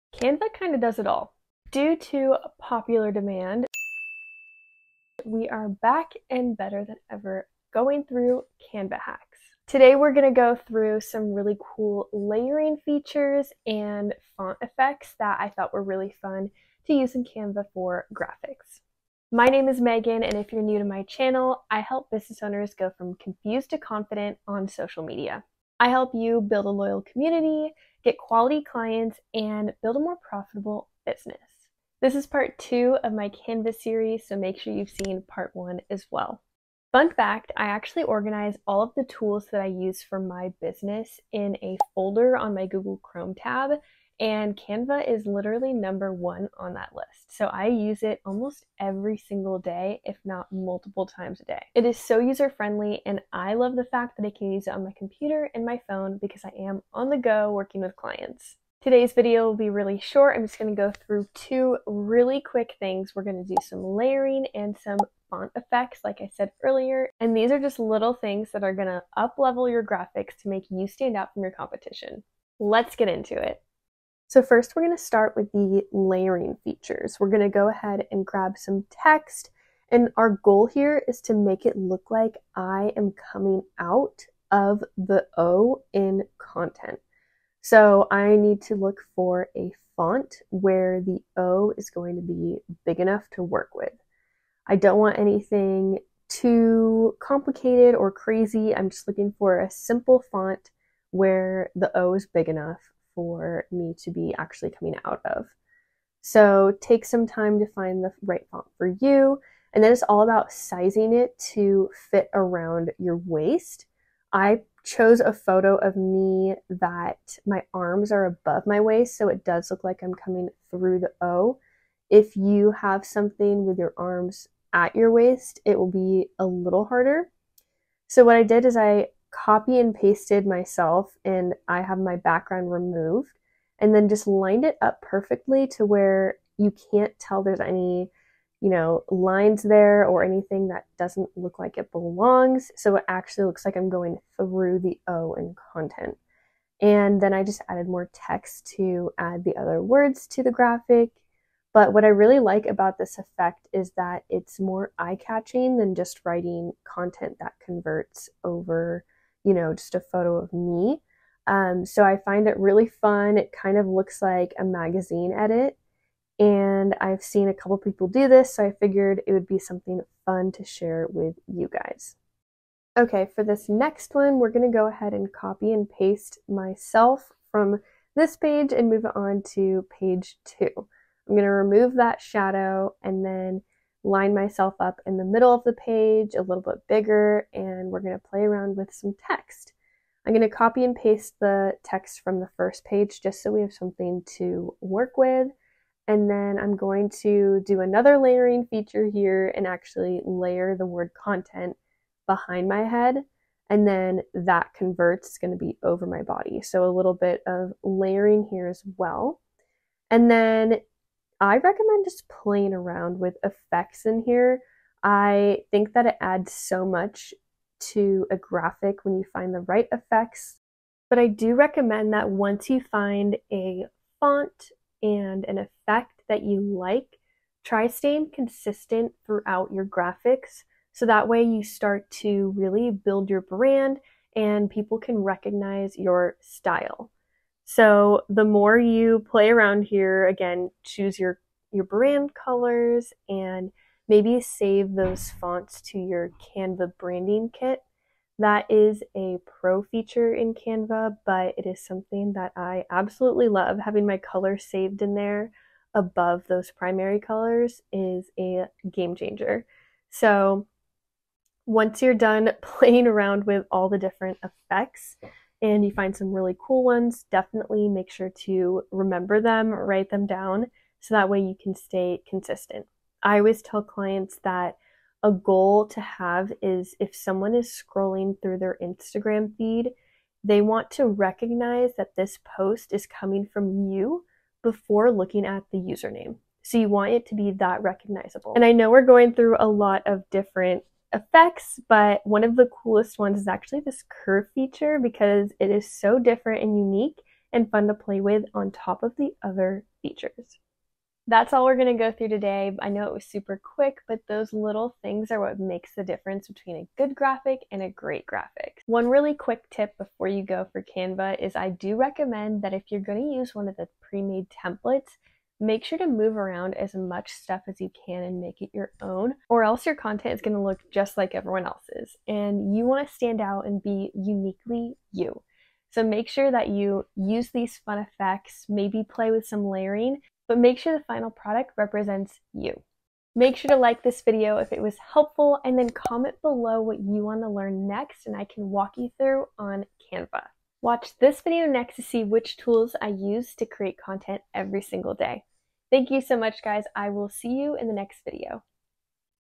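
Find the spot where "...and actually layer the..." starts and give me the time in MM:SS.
03:19.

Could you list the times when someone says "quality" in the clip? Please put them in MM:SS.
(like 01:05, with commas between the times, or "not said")
00:28.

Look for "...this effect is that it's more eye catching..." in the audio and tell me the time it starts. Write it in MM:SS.
02:32.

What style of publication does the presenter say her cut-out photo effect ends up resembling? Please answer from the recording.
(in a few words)
magazine edit.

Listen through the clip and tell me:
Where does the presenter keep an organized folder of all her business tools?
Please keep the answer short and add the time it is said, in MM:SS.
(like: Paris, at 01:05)
Google Chrome tab, at 00:42.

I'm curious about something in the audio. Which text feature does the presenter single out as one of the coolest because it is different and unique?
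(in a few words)
curve feature.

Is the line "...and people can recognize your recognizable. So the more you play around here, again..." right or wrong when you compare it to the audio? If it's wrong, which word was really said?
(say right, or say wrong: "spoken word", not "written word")
wrong: "style", not "recognizable".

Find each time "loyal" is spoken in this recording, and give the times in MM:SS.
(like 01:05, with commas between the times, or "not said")
00:26.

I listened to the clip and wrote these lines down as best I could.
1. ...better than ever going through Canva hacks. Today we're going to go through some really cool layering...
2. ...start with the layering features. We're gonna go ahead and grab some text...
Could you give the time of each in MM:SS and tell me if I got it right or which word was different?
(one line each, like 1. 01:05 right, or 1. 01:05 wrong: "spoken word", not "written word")
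1. 00:06 right
2. 01:14 right.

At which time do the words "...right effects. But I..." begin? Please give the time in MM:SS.
03:39.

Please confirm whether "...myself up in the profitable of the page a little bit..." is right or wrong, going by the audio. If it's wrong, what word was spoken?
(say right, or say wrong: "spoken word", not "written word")
wrong: "middle", not "profitable".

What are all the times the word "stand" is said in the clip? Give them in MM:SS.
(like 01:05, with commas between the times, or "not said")
01:10, 05:23.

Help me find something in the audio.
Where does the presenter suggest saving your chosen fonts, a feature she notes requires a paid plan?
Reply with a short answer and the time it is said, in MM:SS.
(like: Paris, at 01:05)
Canva branding kit, at 04:06.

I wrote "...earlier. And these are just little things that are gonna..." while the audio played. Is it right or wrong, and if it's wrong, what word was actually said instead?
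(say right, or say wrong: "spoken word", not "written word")
right.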